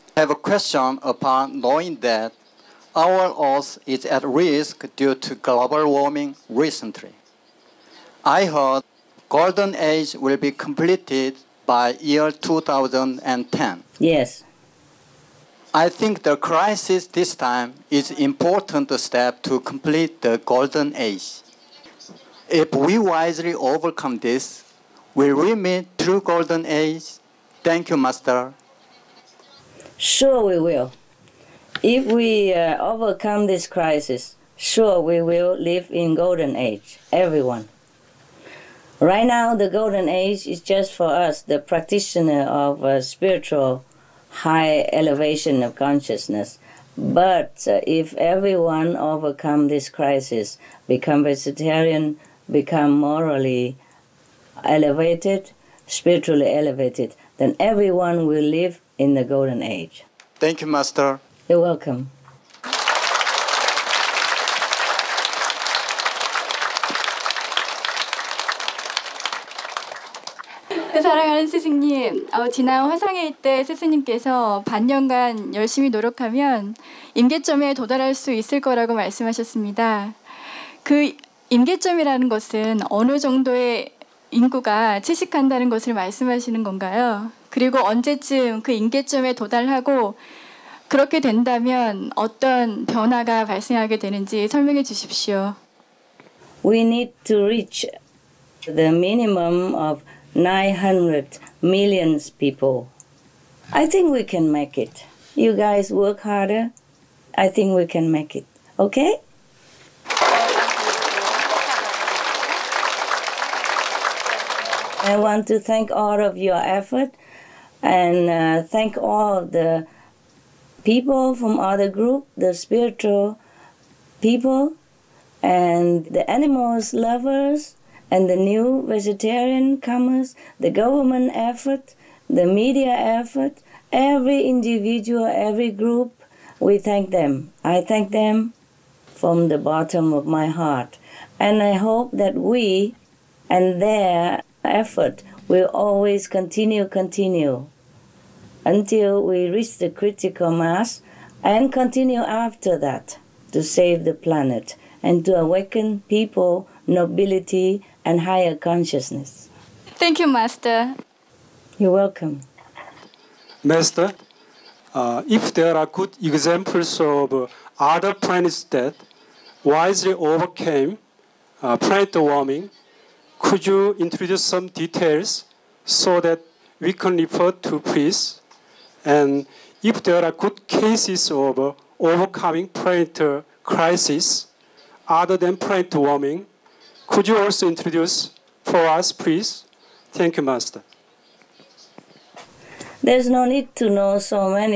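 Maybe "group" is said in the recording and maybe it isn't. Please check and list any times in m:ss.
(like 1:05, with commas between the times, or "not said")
2:01, 2:15.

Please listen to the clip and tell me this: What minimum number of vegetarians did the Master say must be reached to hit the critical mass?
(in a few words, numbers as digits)
900 million.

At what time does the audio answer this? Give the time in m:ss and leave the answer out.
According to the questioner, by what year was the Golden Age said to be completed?
0:12.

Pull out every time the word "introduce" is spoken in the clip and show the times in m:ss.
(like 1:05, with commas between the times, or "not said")
2:53, 3:07.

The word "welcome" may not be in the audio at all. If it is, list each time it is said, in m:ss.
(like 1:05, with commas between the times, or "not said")
1:01, 2:41.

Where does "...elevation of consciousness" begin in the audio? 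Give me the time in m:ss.
0:44.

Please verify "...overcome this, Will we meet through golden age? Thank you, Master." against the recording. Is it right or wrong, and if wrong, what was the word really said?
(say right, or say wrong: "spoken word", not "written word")
right.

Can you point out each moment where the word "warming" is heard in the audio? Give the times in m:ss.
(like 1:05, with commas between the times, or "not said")
0:05, 2:52, 3:05.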